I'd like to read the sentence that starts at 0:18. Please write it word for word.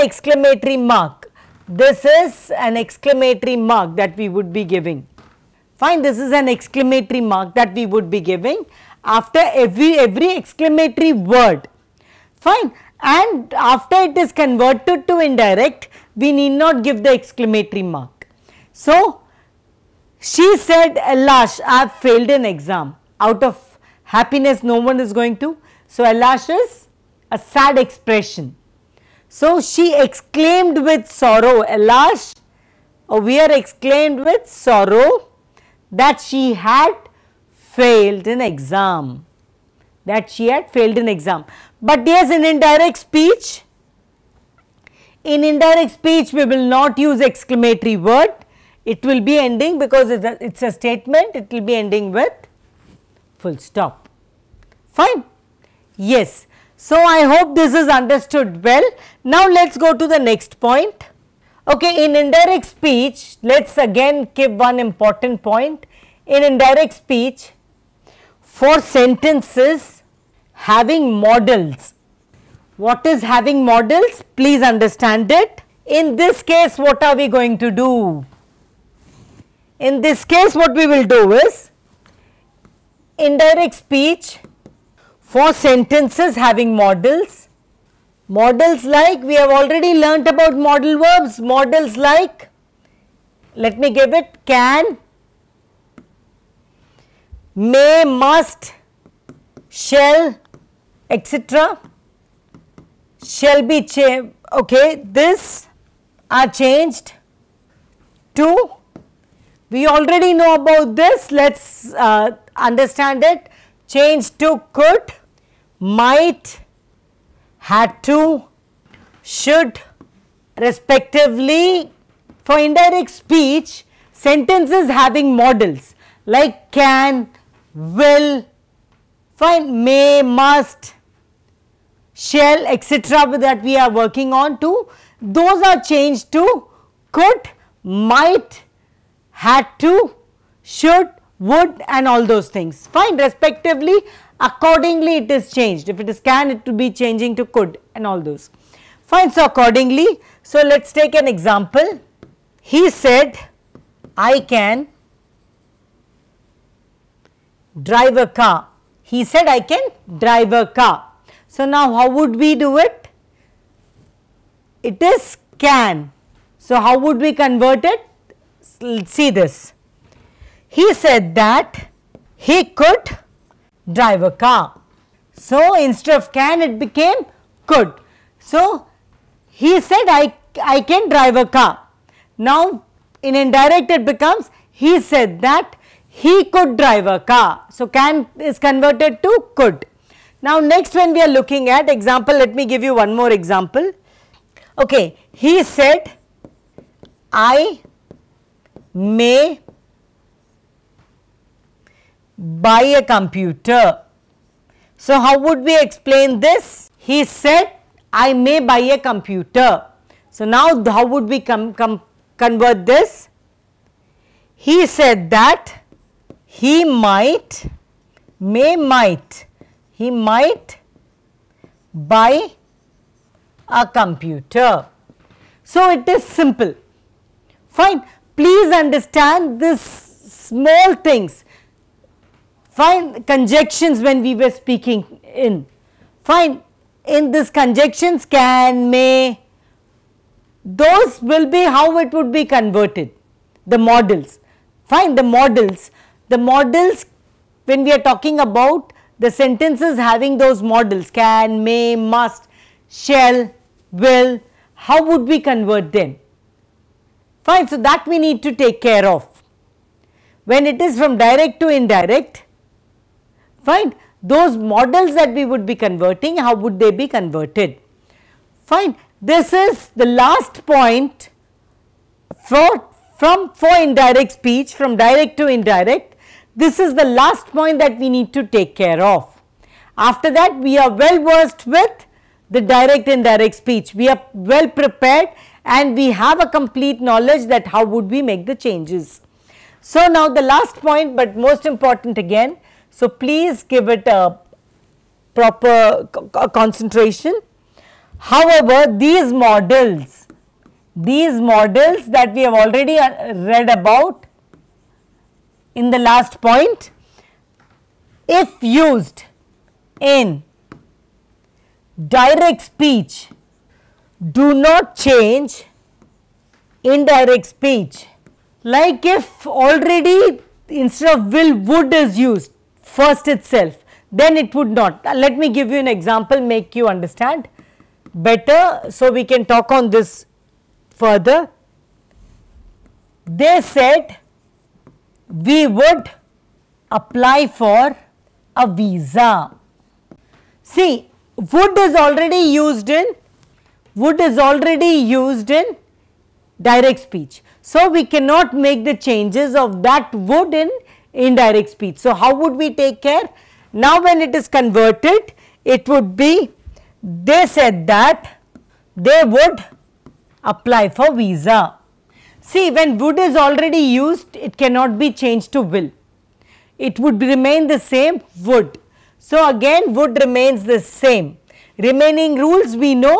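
So, she said, Elash, eh, I have failed an exam.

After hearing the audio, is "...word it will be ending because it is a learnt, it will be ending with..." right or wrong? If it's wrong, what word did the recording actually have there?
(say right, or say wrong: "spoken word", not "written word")
wrong: "statement", not "learnt".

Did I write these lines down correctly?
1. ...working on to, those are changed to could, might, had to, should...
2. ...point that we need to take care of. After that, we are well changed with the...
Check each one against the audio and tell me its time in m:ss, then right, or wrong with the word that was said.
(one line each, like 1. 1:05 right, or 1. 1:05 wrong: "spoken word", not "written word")
1. 2:13 right
2. 4:37 wrong: "versed", not "changed".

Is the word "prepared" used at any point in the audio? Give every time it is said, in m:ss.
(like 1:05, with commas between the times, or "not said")
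4:44.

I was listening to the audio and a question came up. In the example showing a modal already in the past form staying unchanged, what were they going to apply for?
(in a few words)
a visa.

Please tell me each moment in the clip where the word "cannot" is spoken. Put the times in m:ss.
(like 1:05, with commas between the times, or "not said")
5:48, 6:04.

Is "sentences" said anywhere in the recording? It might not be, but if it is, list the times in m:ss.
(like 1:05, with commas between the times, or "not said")
1:08, 1:25, 2:04, 4:09.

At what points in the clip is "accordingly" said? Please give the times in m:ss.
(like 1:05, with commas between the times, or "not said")
2:24, 2:29.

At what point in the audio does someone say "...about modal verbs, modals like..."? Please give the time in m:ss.
1:30.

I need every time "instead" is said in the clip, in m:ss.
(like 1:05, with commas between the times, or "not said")
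2:55, 5:20.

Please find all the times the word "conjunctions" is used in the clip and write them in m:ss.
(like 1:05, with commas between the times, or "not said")
3:53, 3:57.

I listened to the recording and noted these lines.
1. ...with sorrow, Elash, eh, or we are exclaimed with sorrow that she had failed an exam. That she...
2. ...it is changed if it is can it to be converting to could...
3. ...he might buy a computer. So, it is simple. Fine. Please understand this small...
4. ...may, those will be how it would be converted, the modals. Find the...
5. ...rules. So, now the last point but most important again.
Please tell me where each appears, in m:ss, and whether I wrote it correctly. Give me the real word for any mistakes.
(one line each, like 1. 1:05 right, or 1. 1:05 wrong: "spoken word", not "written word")
1. 0:30 right
2. 2:25 wrong: "changing", not "converting"
3. 3:39 right
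4. 3:58 right
5. 4:48 wrong: "changes", not "rules".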